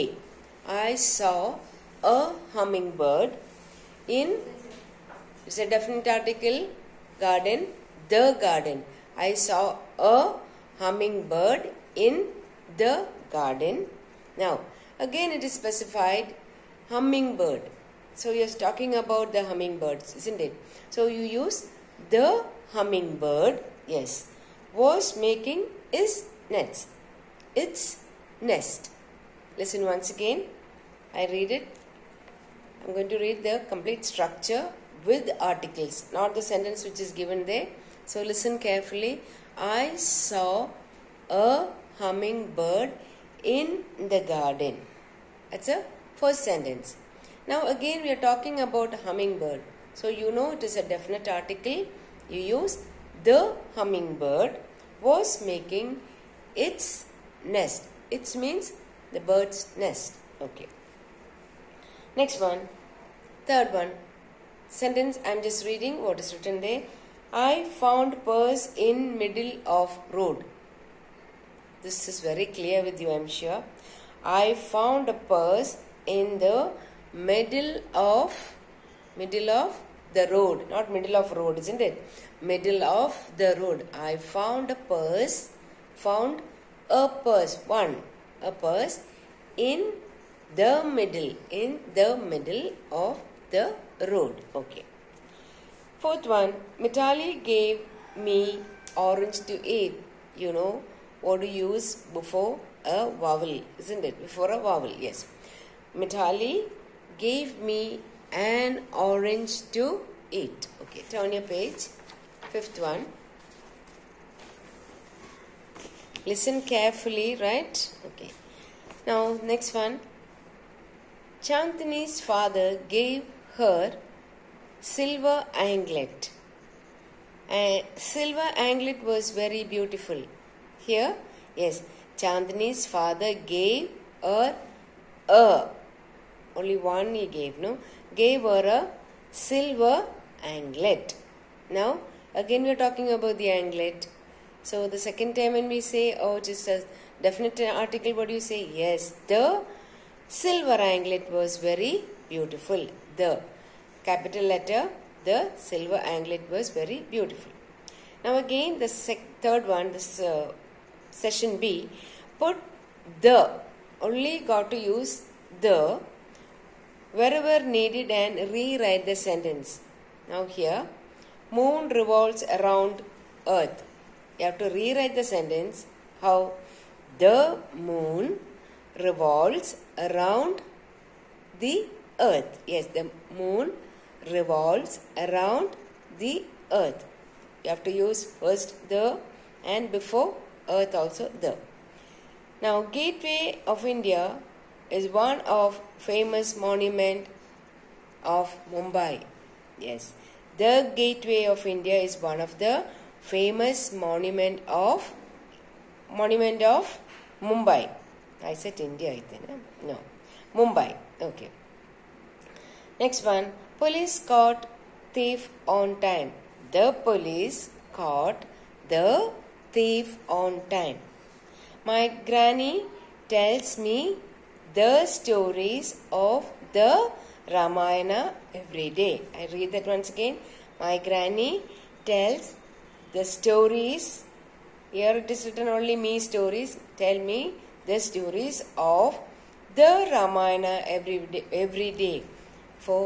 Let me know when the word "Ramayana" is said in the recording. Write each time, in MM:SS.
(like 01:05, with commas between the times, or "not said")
03:47, 04:00.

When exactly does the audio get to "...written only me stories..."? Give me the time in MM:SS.
03:55.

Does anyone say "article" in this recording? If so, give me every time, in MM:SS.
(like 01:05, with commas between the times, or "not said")
00:06, 00:35, 00:51, 02:27.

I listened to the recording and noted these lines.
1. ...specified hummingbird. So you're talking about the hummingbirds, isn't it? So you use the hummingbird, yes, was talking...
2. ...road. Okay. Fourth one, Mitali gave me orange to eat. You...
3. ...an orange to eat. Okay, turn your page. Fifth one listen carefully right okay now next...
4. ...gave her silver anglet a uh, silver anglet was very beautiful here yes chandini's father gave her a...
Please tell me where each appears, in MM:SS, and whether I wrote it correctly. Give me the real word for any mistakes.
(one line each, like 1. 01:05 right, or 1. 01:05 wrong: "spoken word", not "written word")
1. 00:15 wrong: "making", not "talking"
2. 01:34 right
3. 01:48 right
4. 02:02 right.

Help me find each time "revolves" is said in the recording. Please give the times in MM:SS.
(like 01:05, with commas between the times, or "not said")
02:51, 02:58, 03:04.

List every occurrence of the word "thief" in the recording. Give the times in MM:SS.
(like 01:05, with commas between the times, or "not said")
03:35, 03:39.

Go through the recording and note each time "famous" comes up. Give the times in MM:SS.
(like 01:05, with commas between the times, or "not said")
03:15, 03:23.